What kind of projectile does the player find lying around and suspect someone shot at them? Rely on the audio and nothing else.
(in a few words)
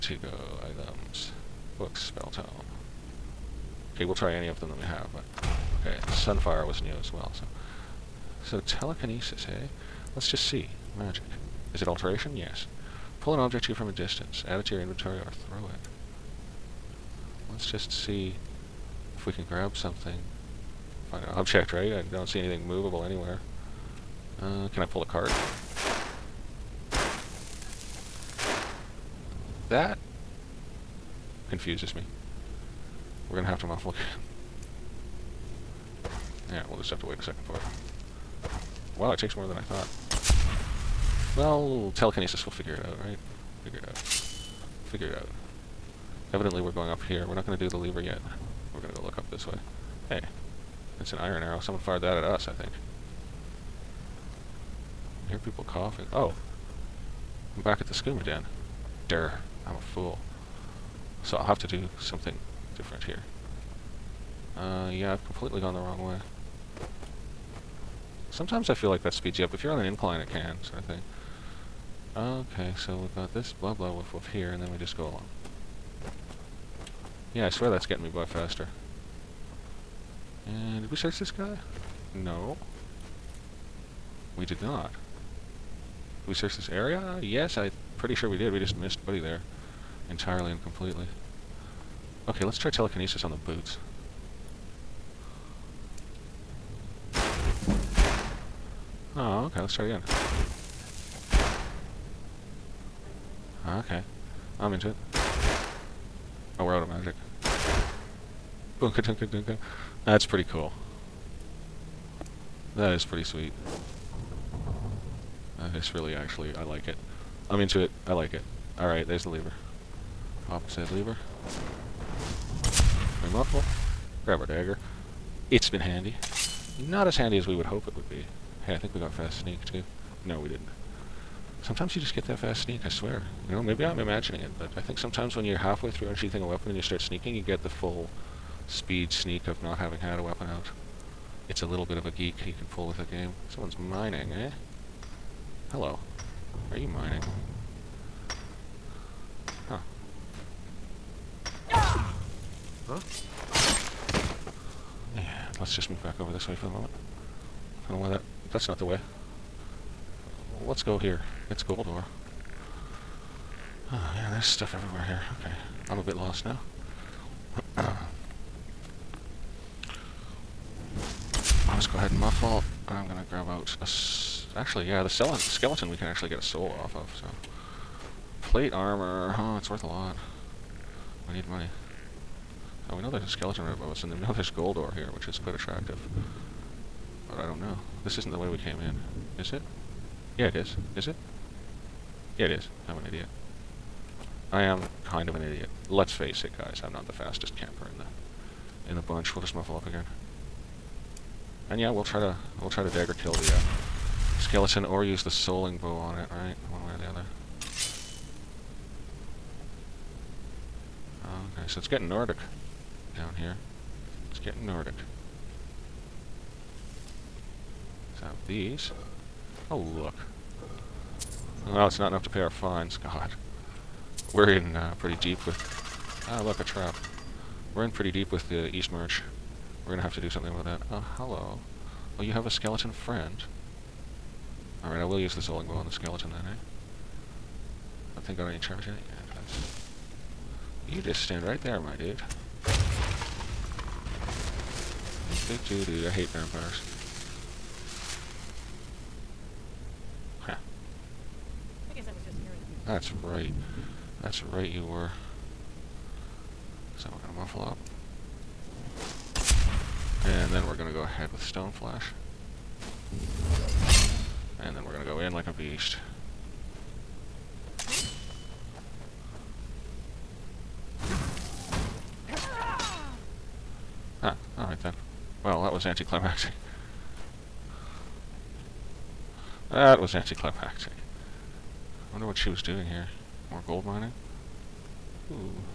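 Iron arrow.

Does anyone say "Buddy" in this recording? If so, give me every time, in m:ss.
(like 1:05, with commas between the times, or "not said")
1:29.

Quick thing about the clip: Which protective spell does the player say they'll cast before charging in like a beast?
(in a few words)
Stone Flesh.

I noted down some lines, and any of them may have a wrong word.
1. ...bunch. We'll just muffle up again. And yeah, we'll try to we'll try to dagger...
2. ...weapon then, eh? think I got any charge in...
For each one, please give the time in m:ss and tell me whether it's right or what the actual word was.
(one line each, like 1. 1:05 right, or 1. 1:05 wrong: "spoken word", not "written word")
1. 3:18 right
2. 3:55 wrong: "skeleton", not "weapon".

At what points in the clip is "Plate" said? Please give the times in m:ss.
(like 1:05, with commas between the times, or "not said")
2:58.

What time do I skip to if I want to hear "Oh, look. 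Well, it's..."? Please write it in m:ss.
3:39.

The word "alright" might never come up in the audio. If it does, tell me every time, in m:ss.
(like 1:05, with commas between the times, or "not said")
1:58, 3:54, 4:34.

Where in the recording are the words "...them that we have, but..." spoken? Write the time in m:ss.
0:04.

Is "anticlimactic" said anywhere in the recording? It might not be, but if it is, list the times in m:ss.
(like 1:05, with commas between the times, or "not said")
4:35, 4:40.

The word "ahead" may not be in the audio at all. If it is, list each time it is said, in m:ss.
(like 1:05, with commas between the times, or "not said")
2:52, 4:21.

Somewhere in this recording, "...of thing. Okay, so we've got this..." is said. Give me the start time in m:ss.
1:10.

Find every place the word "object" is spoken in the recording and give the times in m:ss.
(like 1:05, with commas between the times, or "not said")
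0:13, 0:21.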